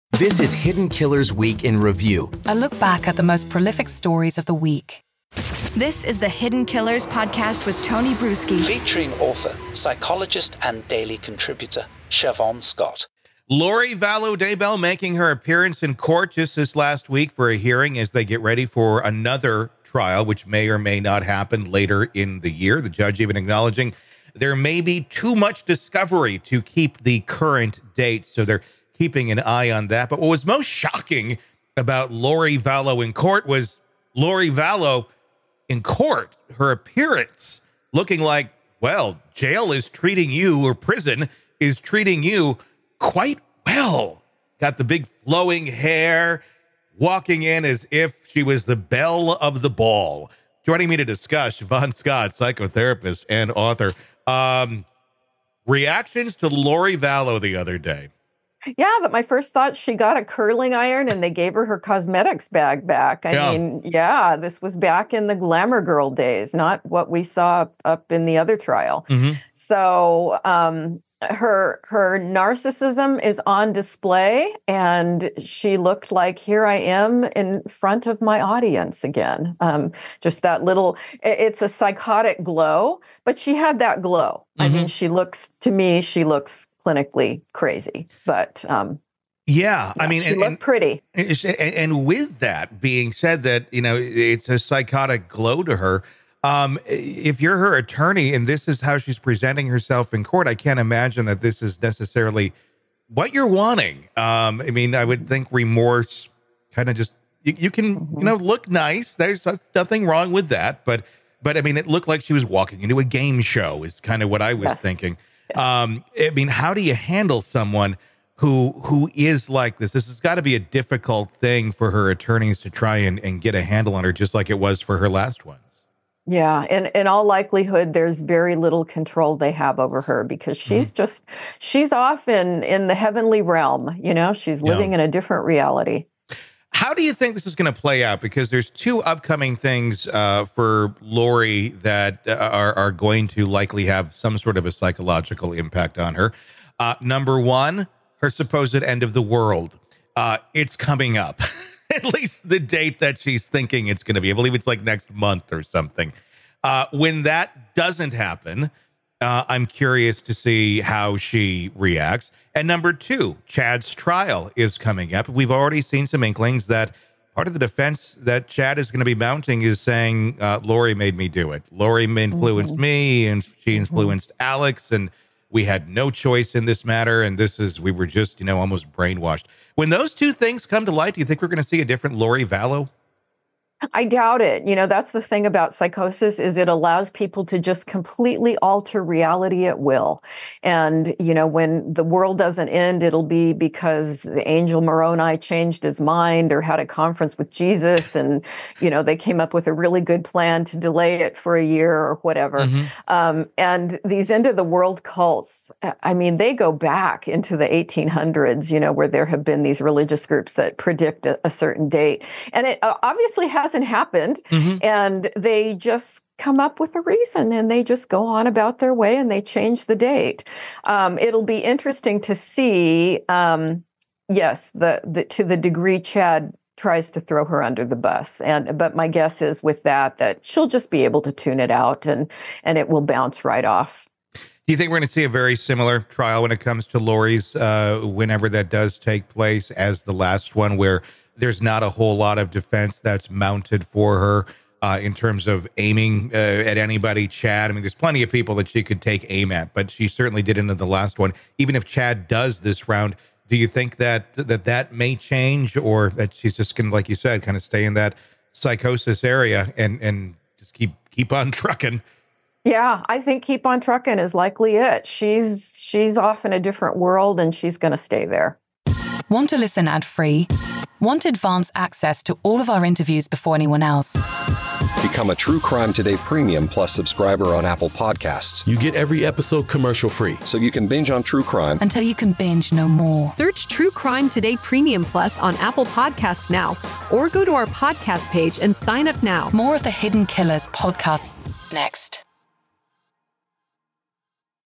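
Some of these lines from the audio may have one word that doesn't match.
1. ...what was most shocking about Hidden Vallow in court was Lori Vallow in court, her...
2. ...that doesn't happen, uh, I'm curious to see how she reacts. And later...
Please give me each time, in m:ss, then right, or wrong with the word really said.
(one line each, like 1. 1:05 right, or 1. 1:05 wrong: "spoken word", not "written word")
1. 0:30 wrong: "Lori", not "Hidden"
2. 2:37 wrong: "number", not "later".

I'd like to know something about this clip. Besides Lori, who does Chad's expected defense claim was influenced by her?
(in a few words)
Alex.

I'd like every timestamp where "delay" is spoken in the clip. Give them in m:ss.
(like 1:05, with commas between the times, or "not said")
3:20.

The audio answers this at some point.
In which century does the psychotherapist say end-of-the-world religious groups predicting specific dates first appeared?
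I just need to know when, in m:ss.
3:27.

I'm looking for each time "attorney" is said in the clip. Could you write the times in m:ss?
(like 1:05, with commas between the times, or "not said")
1:37, 2:02.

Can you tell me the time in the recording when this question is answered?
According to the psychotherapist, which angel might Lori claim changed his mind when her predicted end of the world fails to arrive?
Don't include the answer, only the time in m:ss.
3:14.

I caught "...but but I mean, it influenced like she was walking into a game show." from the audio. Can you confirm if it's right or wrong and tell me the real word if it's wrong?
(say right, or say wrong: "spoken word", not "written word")
wrong: "looked", not "influenced".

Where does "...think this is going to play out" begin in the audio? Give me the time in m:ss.
2:17.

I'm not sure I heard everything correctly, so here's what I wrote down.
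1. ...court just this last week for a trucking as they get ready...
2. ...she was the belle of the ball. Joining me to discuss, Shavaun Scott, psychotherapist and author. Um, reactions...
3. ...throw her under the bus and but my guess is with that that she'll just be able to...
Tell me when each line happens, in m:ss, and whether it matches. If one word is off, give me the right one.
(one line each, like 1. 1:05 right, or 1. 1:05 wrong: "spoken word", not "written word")
1. 0:15 wrong: "hearing", not "trucking"
2. 0:48 right
3. 3:47 right.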